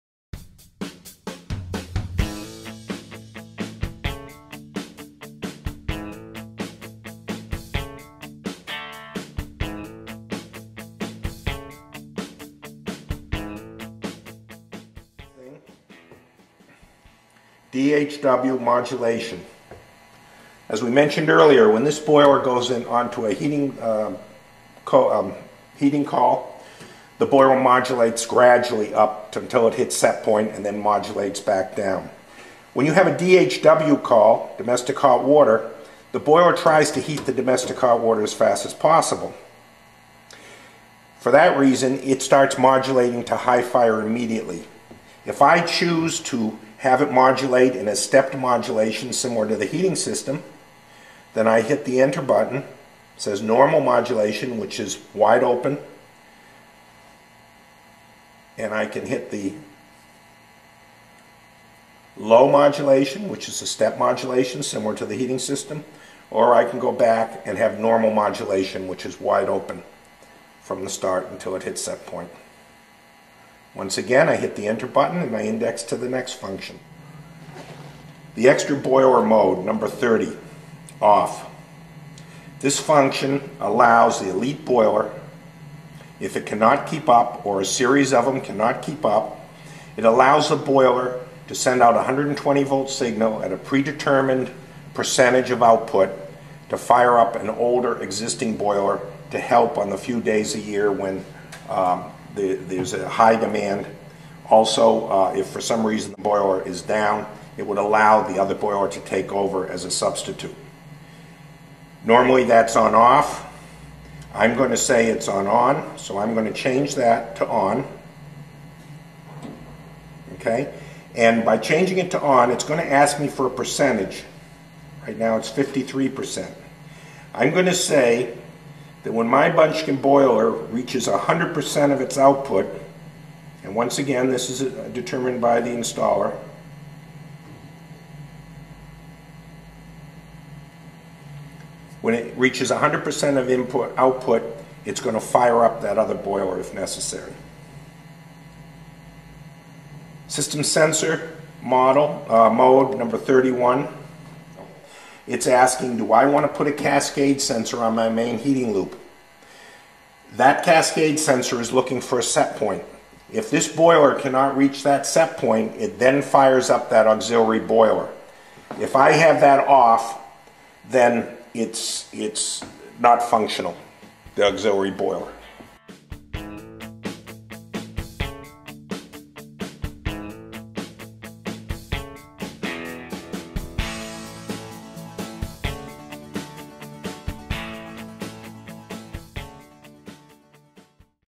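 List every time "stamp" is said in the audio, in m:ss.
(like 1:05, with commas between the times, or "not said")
not said.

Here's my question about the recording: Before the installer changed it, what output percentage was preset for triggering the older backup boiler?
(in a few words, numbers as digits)
53%.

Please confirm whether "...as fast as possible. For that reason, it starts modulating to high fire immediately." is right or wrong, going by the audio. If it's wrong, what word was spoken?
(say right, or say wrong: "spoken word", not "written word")
right.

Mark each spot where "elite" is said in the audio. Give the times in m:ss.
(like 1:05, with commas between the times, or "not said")
1:24.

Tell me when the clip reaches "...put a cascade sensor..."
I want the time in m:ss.
2:36.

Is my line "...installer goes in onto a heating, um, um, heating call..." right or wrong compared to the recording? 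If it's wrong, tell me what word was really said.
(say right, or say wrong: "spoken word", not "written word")
wrong: "boiler", not "installer".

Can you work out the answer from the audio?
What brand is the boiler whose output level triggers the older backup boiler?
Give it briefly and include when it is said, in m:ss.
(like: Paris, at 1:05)
Munchkin, at 2:09.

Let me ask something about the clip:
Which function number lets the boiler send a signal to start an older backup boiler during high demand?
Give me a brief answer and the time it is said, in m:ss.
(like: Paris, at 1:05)
30, at 1:19.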